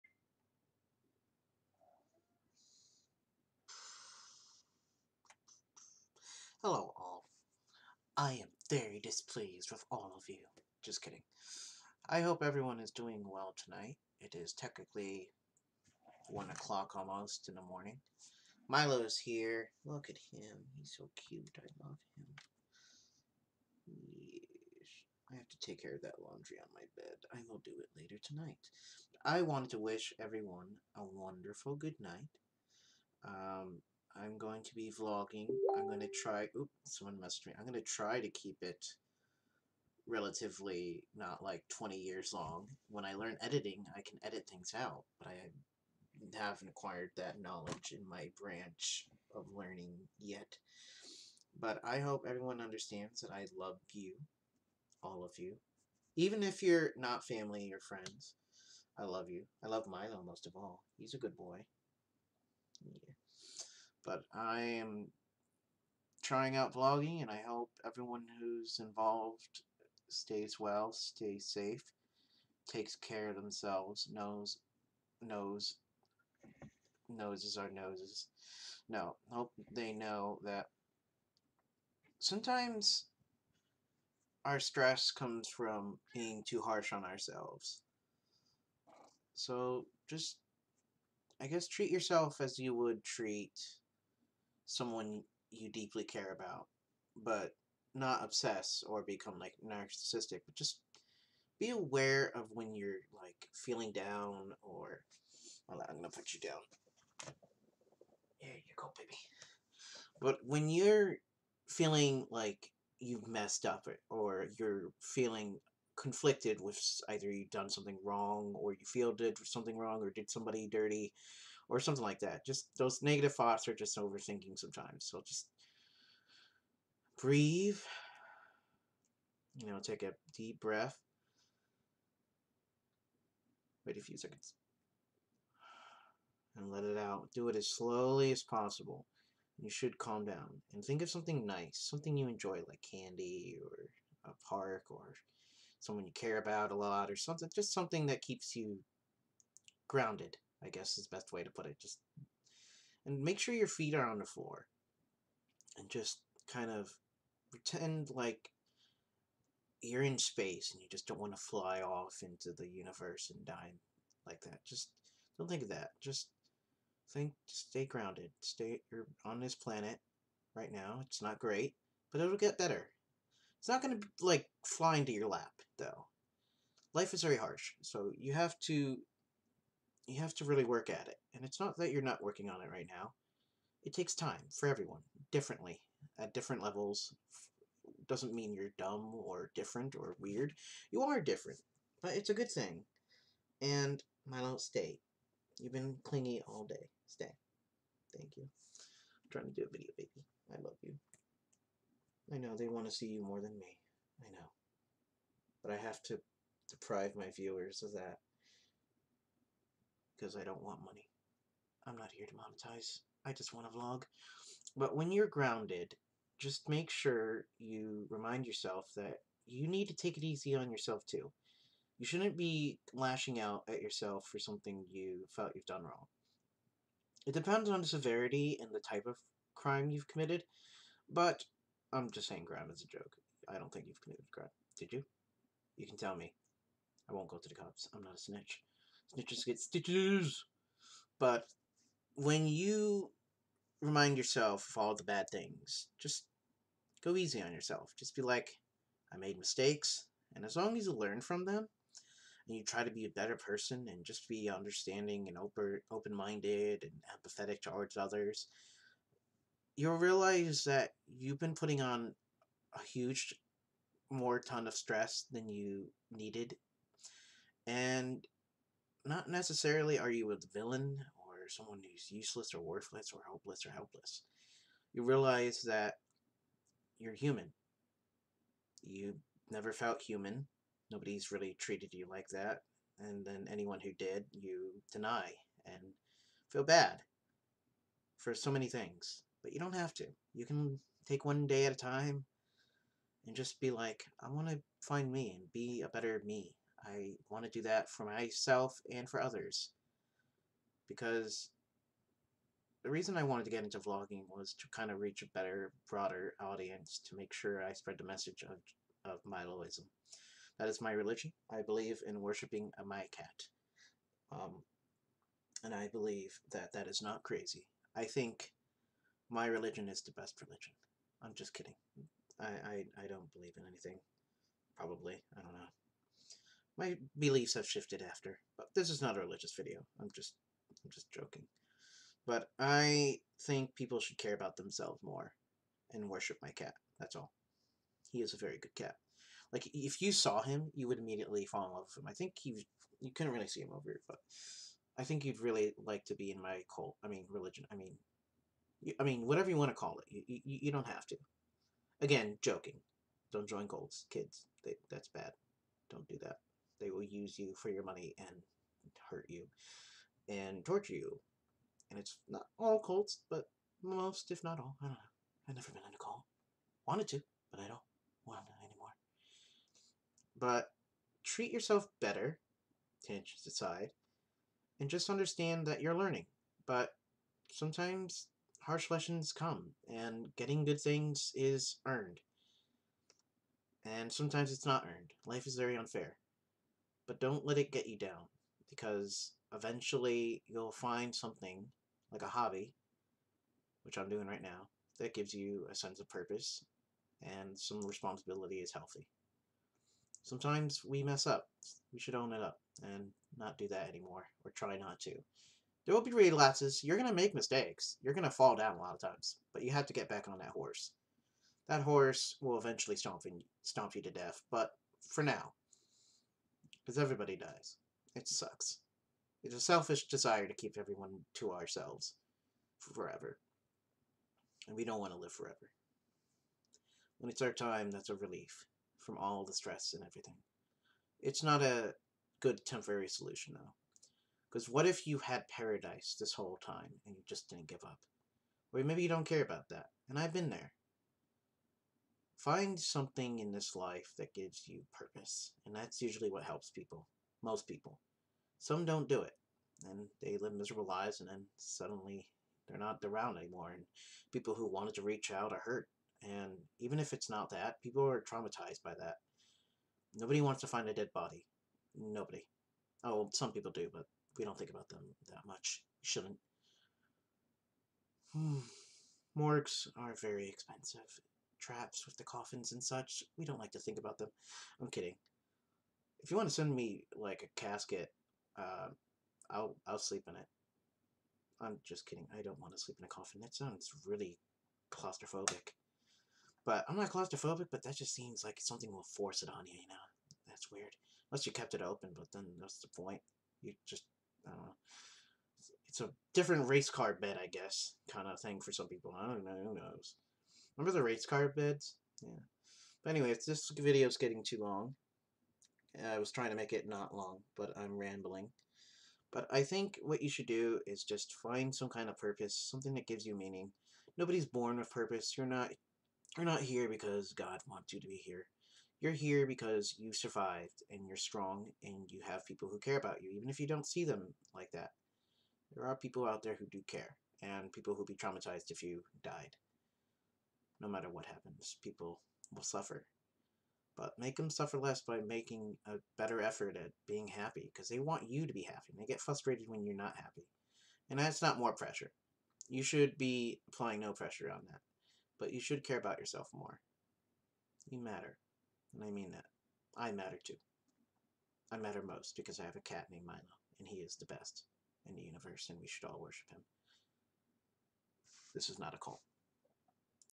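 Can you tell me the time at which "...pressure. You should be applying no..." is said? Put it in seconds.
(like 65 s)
541 s.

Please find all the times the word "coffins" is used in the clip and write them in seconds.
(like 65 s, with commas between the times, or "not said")
472 s, 483 s.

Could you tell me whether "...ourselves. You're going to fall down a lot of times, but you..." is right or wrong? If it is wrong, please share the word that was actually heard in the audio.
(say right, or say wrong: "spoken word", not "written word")
wrong: "mistakes", not "ourselves".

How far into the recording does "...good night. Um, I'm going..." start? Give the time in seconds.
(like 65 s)
31 s.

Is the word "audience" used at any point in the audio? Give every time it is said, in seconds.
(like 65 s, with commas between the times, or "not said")
306 s.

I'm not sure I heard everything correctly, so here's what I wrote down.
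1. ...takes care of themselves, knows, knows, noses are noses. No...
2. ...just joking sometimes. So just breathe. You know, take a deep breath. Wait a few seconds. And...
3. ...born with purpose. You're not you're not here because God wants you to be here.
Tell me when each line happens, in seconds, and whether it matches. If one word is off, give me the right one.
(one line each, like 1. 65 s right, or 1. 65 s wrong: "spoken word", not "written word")
1. 72 s right
2. 123 s wrong: "overthinking", not "joking"
3. 514 s right.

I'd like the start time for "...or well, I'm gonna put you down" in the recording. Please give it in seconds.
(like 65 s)
104 s.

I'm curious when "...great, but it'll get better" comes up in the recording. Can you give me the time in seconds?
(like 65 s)
171 s.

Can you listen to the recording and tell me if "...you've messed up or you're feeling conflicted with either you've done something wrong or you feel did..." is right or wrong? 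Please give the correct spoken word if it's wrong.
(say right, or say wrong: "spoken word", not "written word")
right.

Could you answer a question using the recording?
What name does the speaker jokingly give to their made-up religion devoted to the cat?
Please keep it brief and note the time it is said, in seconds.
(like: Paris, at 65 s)
Miloism, at 309 s.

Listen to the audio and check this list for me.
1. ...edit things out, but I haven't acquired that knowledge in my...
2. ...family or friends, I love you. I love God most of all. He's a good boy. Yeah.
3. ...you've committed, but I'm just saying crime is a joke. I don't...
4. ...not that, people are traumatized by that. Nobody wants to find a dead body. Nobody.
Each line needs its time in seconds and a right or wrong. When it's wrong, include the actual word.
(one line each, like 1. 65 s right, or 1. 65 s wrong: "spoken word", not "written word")
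1. 44 s right
2. 57 s wrong: "Milo", not "God"
3. 229 s right
4. 457 s right.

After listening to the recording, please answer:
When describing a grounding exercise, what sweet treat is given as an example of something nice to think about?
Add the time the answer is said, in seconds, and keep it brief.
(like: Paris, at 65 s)
candy, at 142 s.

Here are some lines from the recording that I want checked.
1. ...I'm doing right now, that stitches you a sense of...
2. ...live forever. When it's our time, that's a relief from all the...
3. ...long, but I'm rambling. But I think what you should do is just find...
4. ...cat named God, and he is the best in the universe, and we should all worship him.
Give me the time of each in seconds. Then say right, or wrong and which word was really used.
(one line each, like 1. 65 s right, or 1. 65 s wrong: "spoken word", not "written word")
1. 393 s wrong: "gives", not "stitches"
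2. 425 s right
3. 507 s right
4. 552 s wrong: "Milo", not "God".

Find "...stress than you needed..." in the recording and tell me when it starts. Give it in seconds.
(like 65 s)
264 s.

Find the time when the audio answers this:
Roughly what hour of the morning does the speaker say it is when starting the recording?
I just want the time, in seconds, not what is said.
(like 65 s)
16 s.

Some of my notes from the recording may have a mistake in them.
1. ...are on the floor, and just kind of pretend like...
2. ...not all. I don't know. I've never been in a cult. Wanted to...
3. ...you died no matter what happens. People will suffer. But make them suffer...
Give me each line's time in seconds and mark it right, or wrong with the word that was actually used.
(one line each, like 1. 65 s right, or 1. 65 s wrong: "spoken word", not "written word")
1. 153 s right
2. 364 s right
3. 528 s right.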